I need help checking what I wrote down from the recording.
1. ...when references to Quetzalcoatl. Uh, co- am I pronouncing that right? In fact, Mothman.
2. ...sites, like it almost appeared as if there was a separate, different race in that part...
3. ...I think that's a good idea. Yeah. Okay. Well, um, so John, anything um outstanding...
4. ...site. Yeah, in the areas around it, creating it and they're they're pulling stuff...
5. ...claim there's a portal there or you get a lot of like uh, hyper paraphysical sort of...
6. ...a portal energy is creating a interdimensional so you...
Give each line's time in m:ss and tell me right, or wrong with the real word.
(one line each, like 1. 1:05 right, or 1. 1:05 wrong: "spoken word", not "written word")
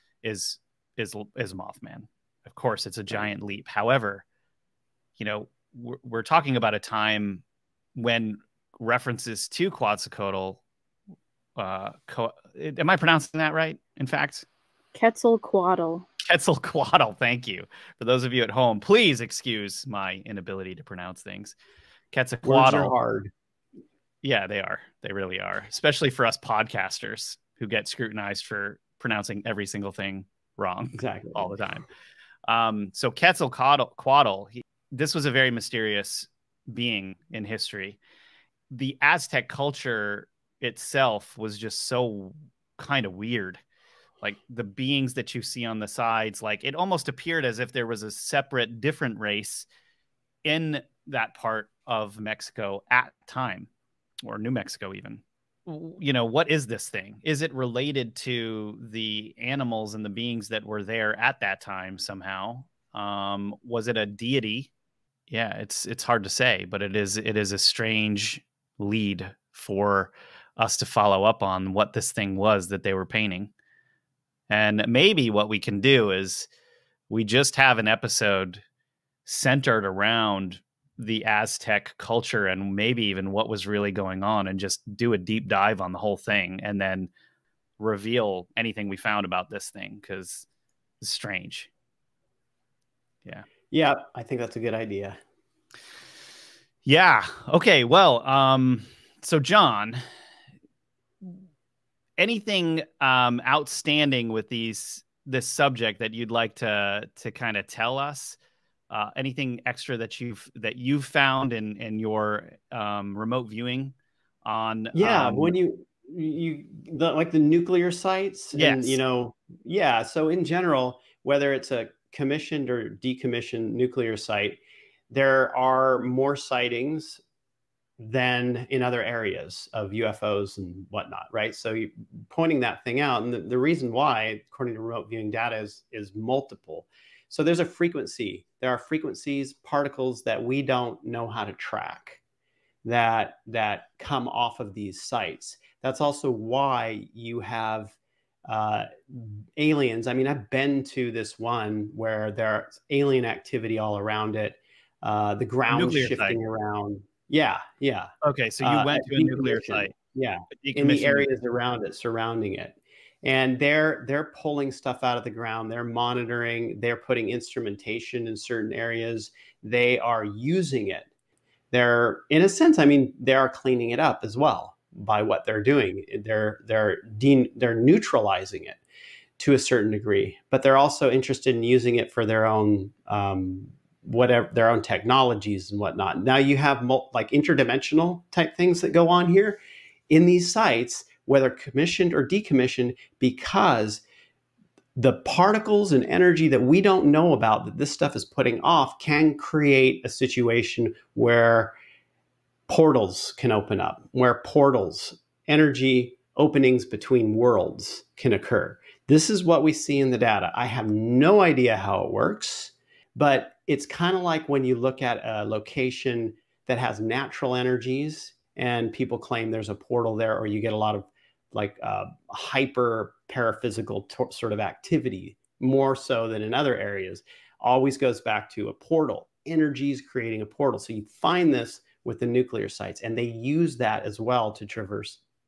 1. 0:07 wrong: "Quetzalcoatl", not "Mothman"
2. 0:45 wrong: "sides", not "sites"
3. 1:34 right
4. 2:39 wrong: "surrounding", not "creating"
5. 3:39 right
6. 3:48 wrong: "portal", not "interdimensional".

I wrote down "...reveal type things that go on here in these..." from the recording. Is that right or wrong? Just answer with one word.
wrong.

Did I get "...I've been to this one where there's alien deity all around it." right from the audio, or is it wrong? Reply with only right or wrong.
wrong.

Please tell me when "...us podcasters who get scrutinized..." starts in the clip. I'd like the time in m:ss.
0:26.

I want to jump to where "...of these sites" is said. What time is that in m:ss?
2:24.